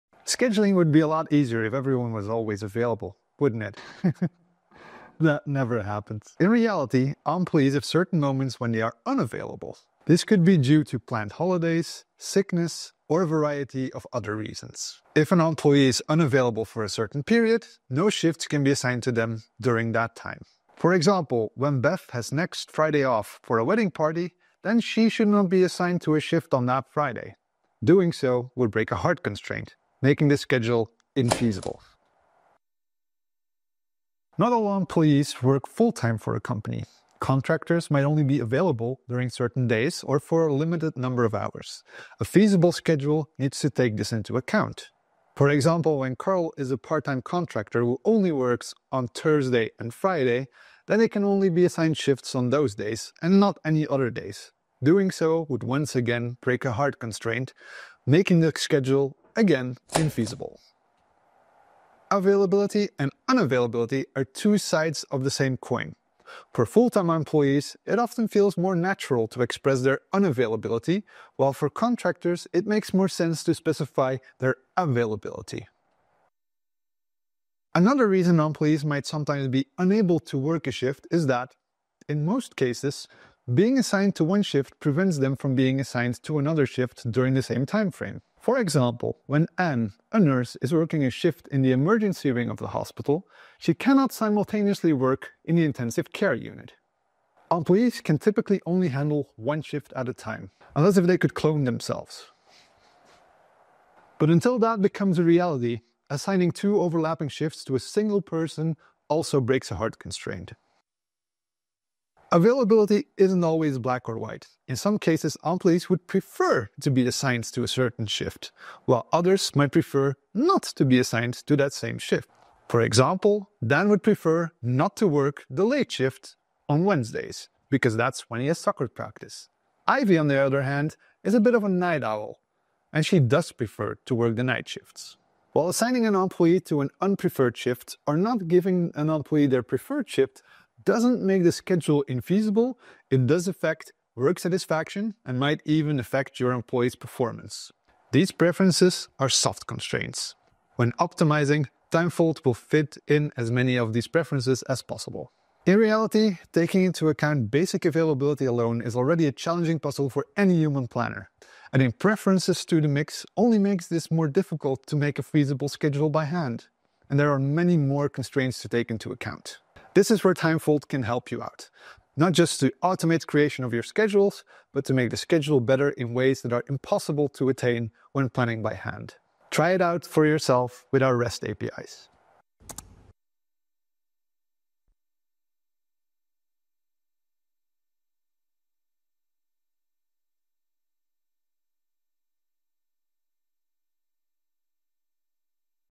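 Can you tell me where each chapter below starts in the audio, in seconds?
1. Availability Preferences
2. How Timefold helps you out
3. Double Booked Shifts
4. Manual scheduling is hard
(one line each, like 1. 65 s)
1. 113 s
2. 170 s
3. 76 s
4. 157 s.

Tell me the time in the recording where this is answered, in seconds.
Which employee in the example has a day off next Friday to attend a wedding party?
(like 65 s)
21 s.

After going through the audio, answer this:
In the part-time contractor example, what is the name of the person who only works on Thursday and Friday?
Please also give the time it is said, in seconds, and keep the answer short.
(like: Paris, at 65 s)
Carl, at 46 s.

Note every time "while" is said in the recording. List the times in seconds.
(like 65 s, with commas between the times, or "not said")
71 s, 118 s, 135 s.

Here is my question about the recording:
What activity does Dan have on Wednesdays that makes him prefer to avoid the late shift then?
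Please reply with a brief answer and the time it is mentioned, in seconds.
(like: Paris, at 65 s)
soccer practice, at 128 s.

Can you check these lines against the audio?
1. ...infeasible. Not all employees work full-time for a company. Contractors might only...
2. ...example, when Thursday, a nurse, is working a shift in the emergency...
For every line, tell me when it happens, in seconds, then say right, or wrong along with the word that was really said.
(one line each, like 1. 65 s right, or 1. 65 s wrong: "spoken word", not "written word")
1. 31 s right
2. 88 s wrong: "Anne", not "Thursday".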